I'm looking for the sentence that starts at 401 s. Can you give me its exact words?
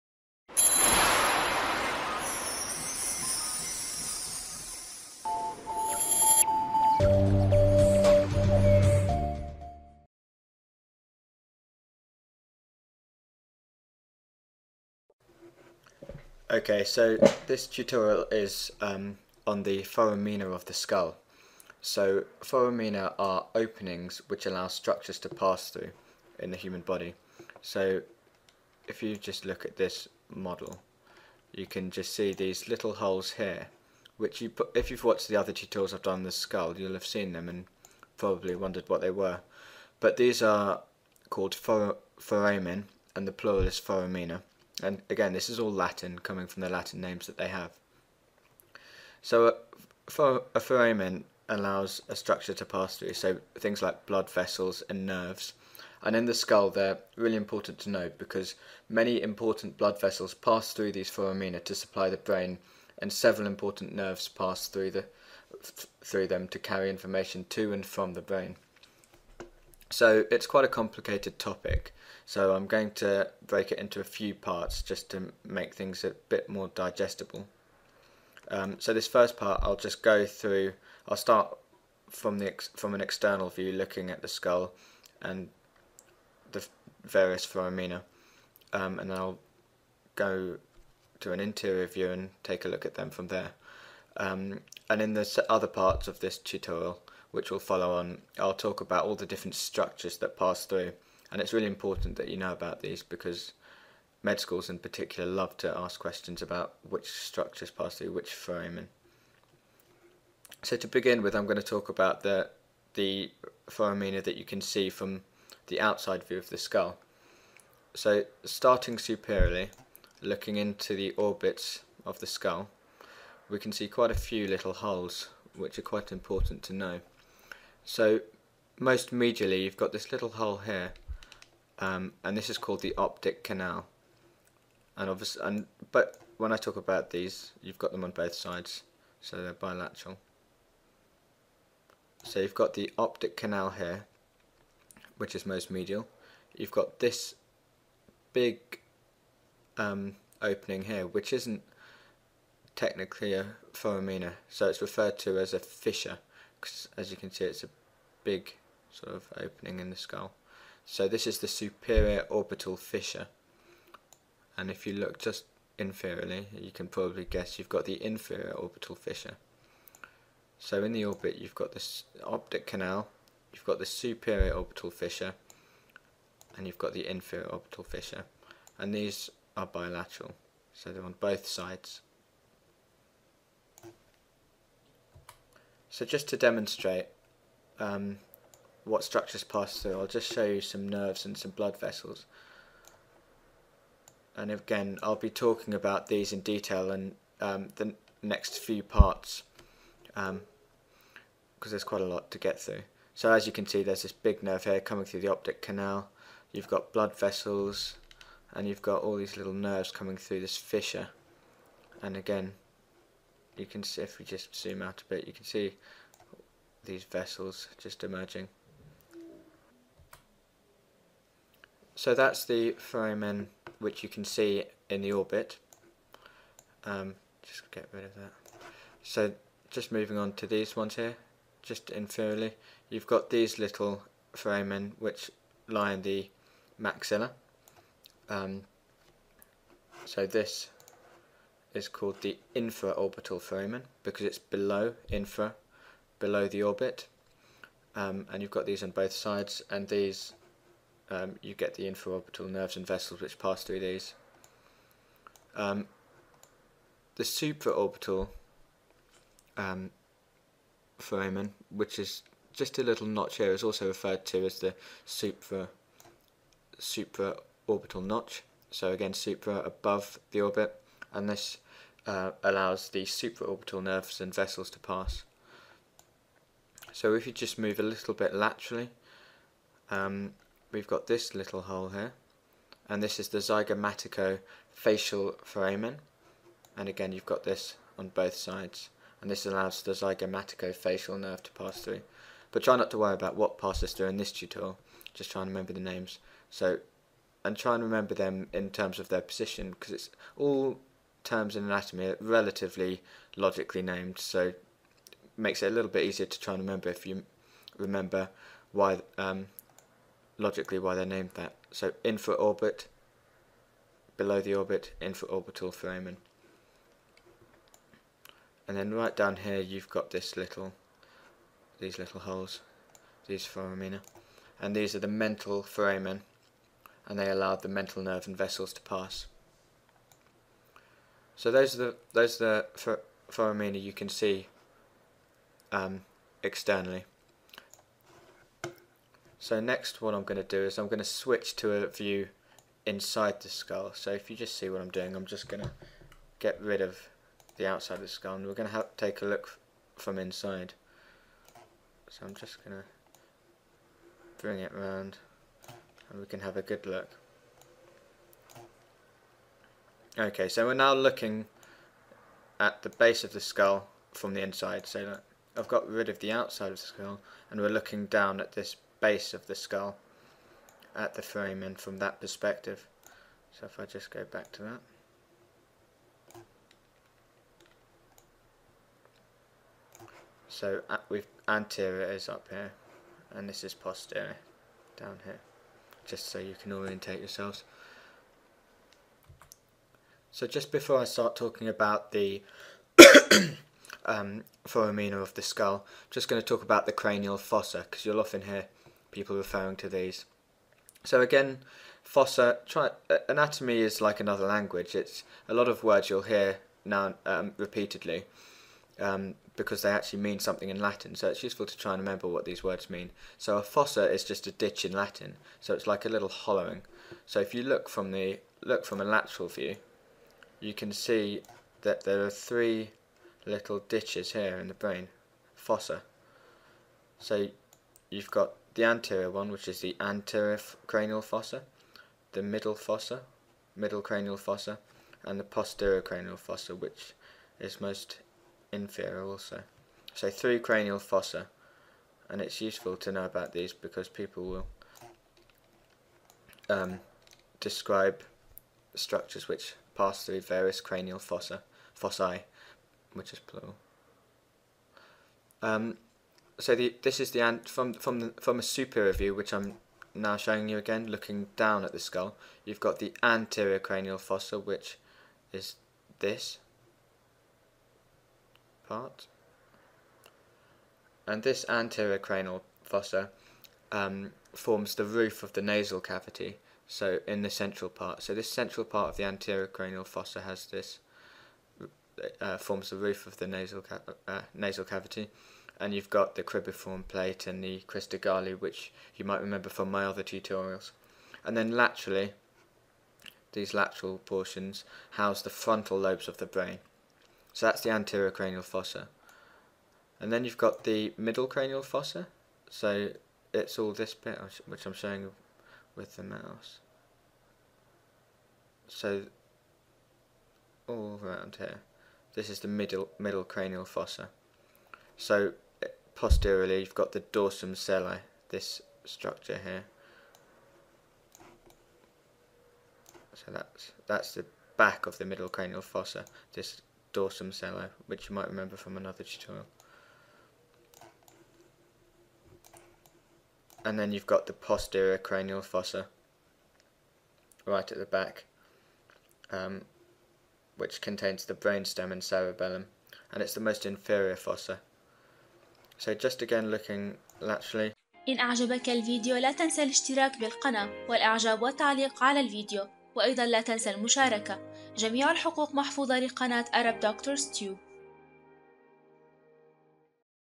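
So again, fossa, try, anatomy is like another language.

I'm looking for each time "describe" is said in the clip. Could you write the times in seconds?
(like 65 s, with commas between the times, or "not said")
447 s.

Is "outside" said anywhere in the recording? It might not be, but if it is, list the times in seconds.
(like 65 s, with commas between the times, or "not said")
115 s, 347 s, 366 s.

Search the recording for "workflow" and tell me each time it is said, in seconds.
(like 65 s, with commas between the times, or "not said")
not said.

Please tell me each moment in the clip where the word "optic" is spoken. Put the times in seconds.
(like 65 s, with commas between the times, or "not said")
132 s, 142 s, 172 s, 205 s.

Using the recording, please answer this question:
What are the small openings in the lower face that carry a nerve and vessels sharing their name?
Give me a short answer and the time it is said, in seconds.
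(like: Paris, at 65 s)
Mental foramen, at 325 s.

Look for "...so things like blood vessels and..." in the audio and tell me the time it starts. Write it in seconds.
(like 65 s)
53 s.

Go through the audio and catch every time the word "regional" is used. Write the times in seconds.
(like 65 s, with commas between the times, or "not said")
not said.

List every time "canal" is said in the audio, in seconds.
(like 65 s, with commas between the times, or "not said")
133 s, 143 s, 172 s, 205 s.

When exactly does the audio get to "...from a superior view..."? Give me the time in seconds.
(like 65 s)
458 s.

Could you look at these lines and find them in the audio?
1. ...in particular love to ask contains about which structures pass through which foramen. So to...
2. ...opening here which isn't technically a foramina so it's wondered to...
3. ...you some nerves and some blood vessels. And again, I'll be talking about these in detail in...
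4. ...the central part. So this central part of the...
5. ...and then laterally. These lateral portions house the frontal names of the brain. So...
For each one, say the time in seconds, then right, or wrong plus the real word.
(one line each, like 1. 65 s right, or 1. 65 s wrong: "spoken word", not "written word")
1. 104 s wrong: "questions", not "contains"
2. 150 s wrong: "referred", not "wondered"
3. 190 s right
4. 477 s right
5. 491 s wrong: "lobes", not "names".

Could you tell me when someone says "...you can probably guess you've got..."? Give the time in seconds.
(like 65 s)
166 s.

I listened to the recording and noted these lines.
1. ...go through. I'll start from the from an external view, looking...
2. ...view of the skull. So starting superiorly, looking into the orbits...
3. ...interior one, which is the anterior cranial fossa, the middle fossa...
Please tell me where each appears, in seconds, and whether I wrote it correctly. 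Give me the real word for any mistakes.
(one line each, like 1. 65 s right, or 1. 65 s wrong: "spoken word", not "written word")
1. 80 s right
2. 116 s right
3. 428 s wrong: "anterior", not "interior".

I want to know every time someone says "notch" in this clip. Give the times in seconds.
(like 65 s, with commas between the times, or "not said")
263 s, 268 s.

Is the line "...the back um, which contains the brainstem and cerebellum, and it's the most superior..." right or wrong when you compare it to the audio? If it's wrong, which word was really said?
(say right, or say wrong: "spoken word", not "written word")
wrong: "inferior", not "superior".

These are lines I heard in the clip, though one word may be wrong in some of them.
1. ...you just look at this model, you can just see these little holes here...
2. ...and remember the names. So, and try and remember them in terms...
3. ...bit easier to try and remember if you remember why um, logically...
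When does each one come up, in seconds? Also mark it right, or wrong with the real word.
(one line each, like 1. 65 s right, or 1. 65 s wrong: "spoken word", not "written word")
1. 29 s right
2. 295 s right
3. 305 s right.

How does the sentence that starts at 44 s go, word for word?
And again, this is all Latin, coming from the Latin names that they have.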